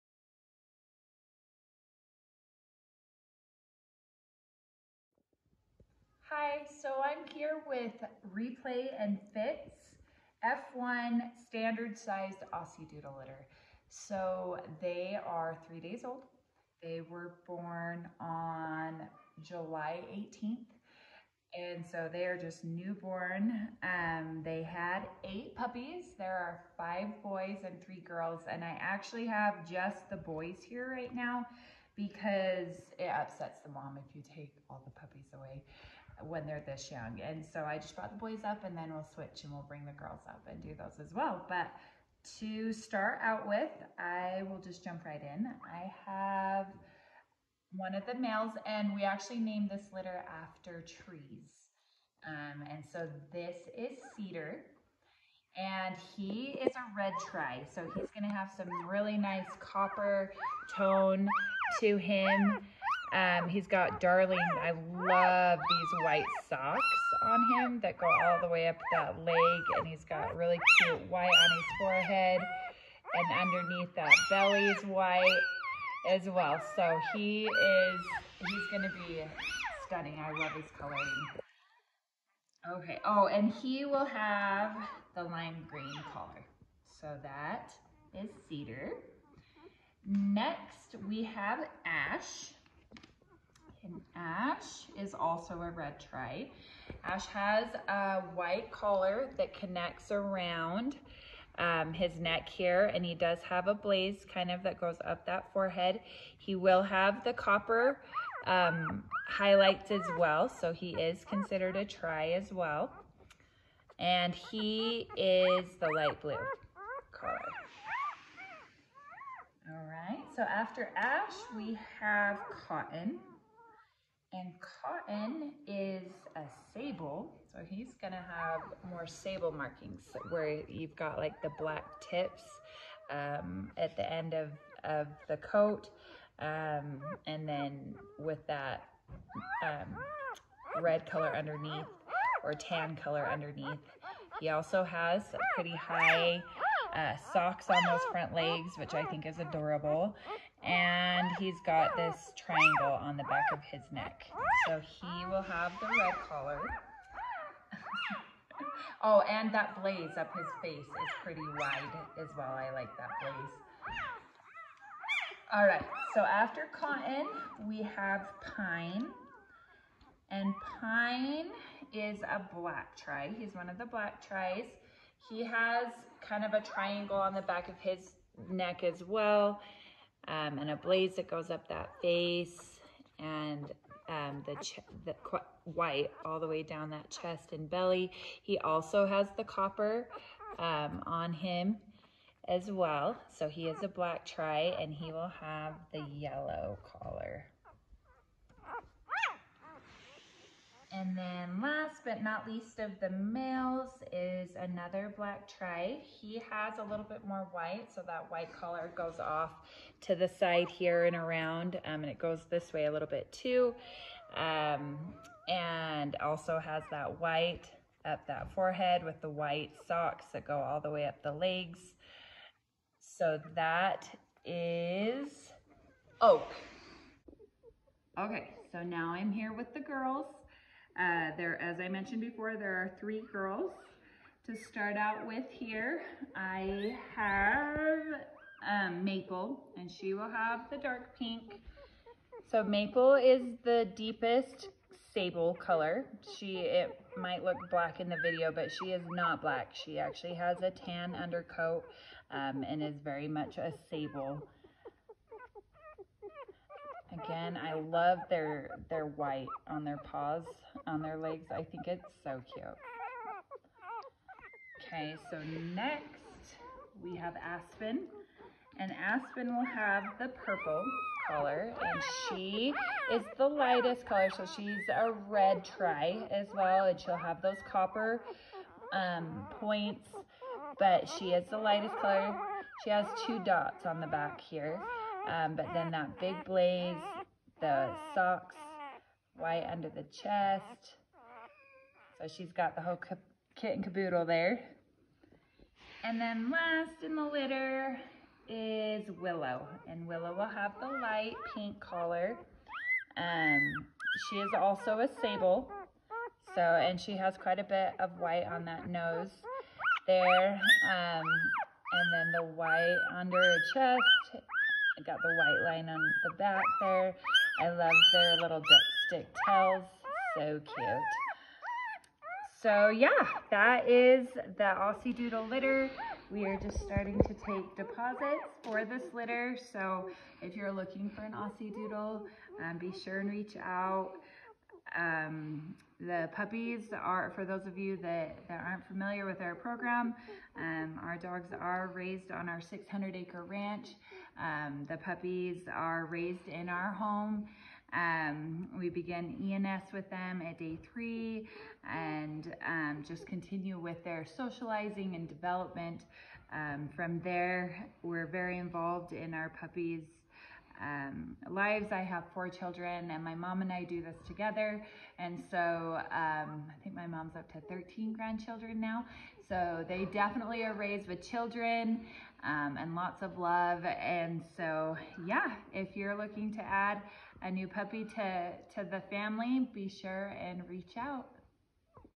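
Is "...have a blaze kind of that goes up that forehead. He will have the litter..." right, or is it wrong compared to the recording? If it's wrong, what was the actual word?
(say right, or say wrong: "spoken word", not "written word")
wrong: "copper", not "litter".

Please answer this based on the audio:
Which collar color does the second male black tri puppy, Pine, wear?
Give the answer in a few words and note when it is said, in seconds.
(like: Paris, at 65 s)
yellow, at 196 s.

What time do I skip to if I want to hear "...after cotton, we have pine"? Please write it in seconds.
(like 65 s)
166 s.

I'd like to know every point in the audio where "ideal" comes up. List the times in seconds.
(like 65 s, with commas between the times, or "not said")
not said.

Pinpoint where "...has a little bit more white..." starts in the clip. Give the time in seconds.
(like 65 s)
206 s.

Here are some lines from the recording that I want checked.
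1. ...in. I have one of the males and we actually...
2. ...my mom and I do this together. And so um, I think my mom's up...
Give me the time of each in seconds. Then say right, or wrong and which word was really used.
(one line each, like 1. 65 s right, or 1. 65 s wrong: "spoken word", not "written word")
1. 45 s right
2. 363 s right.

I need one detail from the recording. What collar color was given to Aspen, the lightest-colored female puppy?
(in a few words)
purple.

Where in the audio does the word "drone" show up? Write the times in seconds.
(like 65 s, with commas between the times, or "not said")
not said.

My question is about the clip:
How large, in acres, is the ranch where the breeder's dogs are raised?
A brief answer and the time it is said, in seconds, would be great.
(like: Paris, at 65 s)
600 acres, at 342 s.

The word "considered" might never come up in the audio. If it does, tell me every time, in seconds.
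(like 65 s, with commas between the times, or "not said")
111 s.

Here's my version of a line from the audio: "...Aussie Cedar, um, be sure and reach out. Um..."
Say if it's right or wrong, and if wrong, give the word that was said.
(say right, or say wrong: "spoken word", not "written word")
wrong: "Doodle", not "Cedar".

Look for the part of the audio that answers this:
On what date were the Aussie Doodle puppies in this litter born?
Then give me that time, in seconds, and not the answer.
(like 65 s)
19 s.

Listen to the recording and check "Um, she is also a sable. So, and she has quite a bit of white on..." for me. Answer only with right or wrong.
right.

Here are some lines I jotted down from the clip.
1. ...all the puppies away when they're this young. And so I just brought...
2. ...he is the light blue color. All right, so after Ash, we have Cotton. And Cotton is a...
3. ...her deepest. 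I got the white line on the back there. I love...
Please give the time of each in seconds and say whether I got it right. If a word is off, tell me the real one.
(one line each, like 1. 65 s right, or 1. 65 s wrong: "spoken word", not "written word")
1. 34 s right
2. 114 s right
3. 313 s wrong: "chest", not "deepest".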